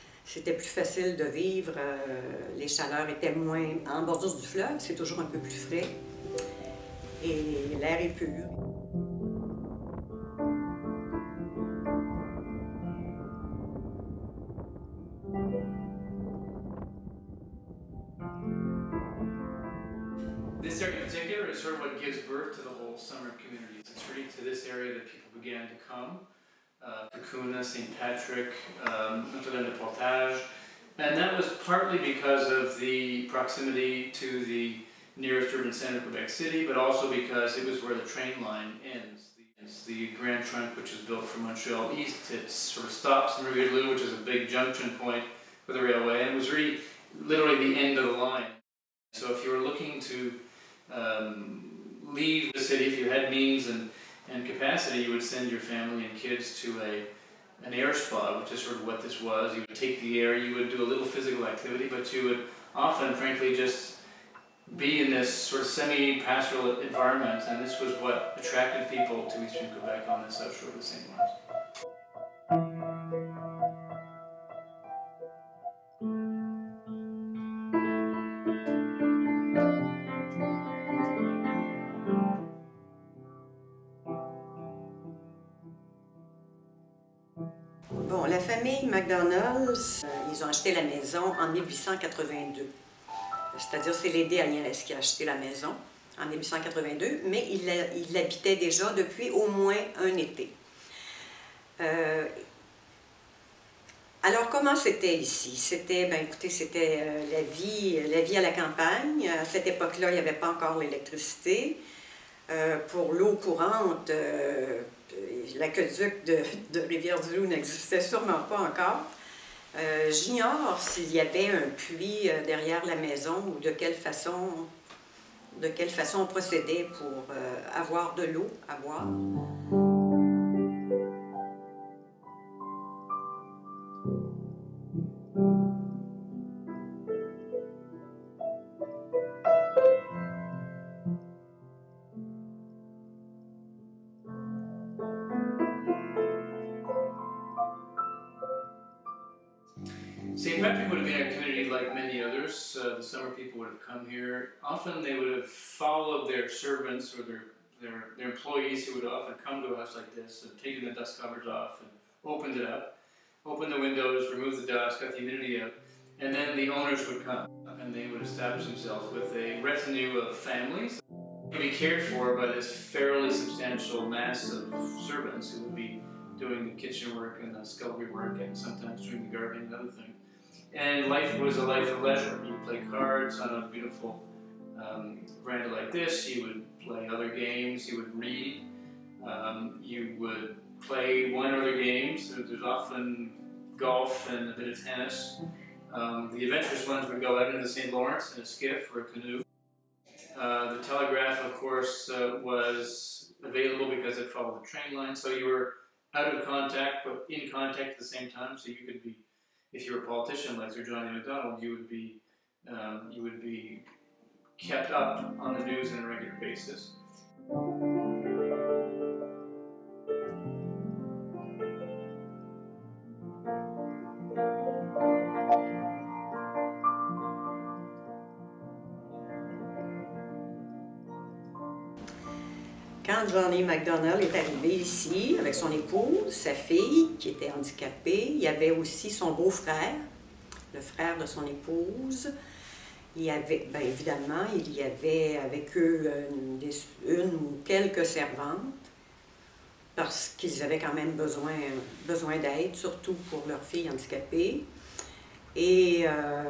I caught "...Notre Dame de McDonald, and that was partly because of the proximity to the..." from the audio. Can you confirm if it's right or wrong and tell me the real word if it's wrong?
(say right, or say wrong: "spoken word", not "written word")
wrong: "Portage", not "McDonald".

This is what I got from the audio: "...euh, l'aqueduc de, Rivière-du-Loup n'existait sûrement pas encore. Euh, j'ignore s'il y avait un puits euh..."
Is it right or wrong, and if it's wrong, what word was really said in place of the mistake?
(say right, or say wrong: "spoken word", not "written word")
right.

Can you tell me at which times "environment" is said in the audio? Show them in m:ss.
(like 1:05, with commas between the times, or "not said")
1:06.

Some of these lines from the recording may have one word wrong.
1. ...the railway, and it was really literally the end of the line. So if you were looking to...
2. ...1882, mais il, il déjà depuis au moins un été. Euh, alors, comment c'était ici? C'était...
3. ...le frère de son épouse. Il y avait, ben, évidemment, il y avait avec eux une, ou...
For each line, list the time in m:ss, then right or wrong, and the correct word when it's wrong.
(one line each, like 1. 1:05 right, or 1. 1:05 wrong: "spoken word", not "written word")
1. 0:45 right
2. 1:36 right
3. 4:00 right.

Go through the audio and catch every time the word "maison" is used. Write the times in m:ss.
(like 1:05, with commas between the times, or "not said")
1:30, 1:35, 2:02.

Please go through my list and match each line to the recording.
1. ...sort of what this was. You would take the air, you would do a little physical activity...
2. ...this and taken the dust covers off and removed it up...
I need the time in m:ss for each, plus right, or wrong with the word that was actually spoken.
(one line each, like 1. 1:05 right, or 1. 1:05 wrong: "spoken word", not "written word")
1. 0:58 right
2. 2:40 wrong: "opened", not "removed".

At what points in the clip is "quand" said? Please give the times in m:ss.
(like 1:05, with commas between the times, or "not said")
3:53, 4:10.